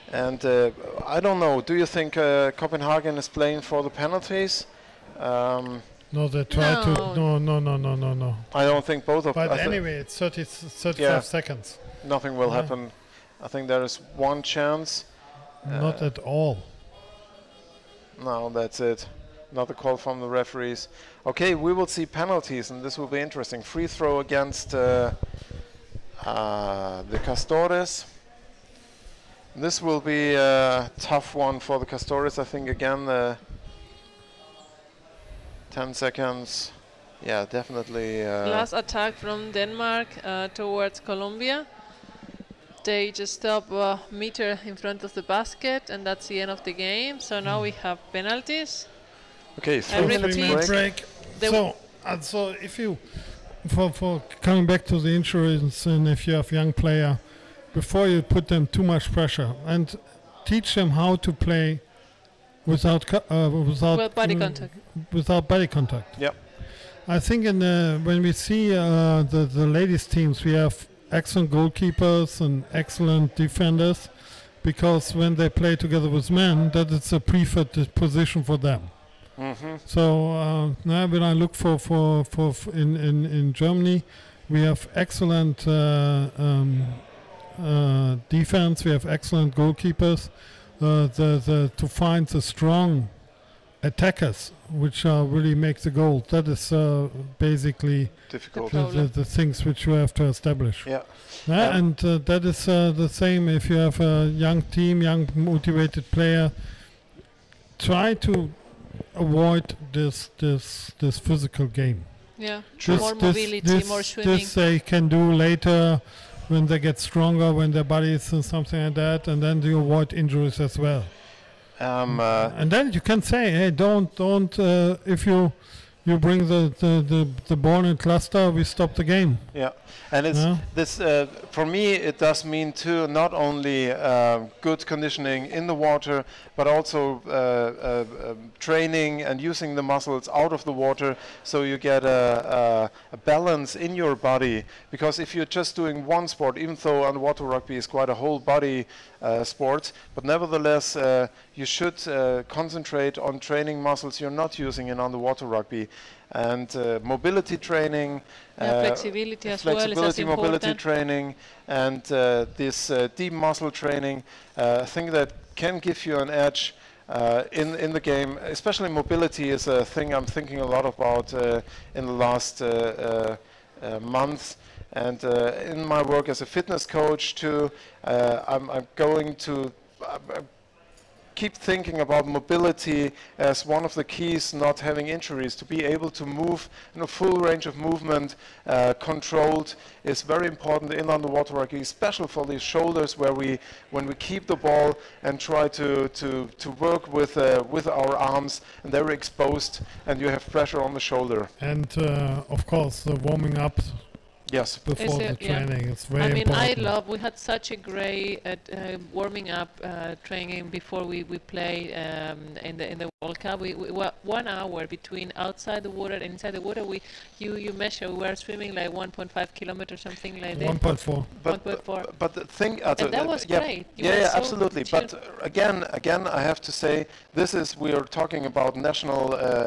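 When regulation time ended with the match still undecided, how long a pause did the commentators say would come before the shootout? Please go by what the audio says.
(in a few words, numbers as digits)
3 minutes.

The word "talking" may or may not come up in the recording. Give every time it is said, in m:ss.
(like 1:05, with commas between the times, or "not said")
3:48.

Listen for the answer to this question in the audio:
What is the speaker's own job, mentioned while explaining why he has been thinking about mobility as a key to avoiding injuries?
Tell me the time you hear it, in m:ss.
2:56.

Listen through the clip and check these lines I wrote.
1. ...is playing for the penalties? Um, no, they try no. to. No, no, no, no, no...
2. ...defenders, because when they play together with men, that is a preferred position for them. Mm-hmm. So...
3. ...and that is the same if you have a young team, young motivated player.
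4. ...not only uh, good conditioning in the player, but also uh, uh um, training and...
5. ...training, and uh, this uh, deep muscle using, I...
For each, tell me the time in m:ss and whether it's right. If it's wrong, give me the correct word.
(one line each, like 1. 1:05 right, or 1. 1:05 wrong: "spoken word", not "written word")
1. 0:03 right
2. 1:13 right
3. 1:41 right
4. 2:13 wrong: "water", not "player"
5. 2:40 wrong: "training", not "using".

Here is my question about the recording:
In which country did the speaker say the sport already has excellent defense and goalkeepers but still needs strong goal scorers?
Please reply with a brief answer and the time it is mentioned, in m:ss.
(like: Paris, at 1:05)
Germany, at 1:23.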